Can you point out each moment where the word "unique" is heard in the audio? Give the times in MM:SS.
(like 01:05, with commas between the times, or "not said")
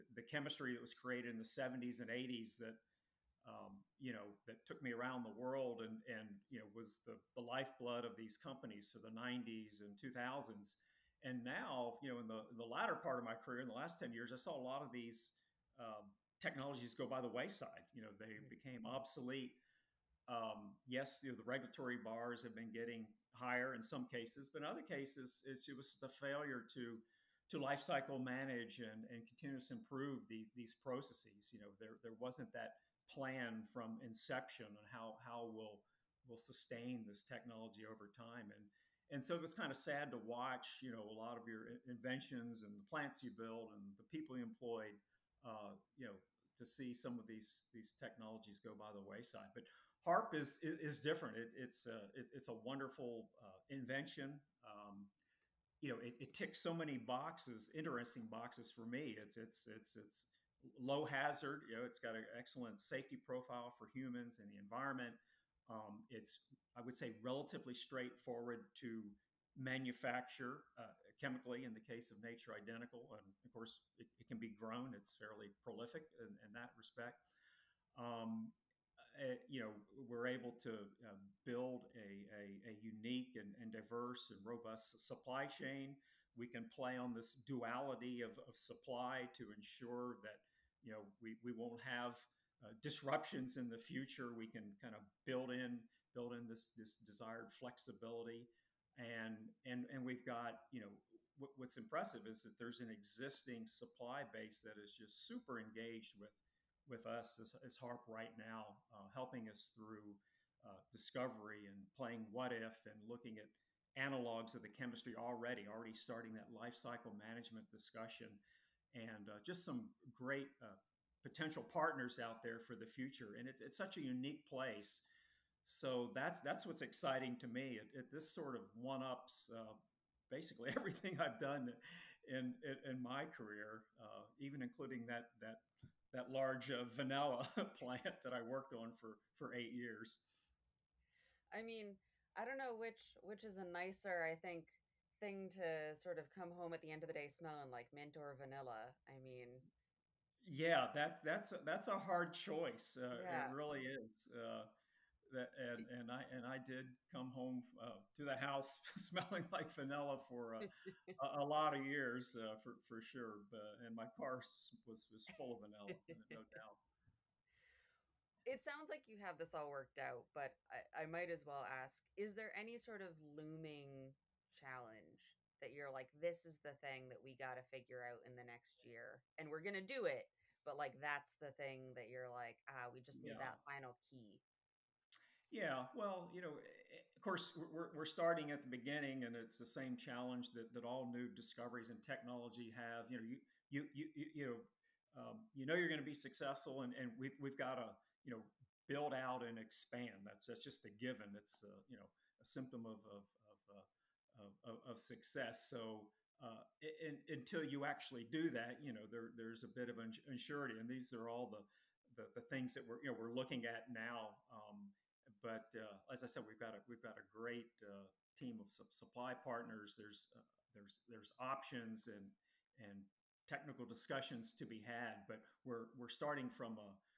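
01:22, 02:04.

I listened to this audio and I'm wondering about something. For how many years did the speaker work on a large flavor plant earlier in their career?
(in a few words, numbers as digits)
8.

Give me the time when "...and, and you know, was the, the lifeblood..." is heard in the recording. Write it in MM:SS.
00:05.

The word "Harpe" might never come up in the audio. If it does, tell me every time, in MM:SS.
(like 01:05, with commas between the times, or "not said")
00:50, 01:47.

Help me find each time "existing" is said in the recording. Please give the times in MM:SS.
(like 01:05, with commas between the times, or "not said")
01:42.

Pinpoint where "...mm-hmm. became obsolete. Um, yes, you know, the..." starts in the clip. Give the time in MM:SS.
00:18.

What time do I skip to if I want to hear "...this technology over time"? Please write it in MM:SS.
00:37.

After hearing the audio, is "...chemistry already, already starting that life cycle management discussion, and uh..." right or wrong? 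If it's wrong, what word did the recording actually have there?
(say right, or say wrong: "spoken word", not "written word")
right.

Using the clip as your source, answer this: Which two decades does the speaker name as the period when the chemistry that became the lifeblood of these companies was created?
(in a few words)
'70s and '80s.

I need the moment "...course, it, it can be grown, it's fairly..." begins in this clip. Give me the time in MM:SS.
01:13.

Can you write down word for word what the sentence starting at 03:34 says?
Um, but uh, as I said, we've got a we've got a great uh, team of su supply partners.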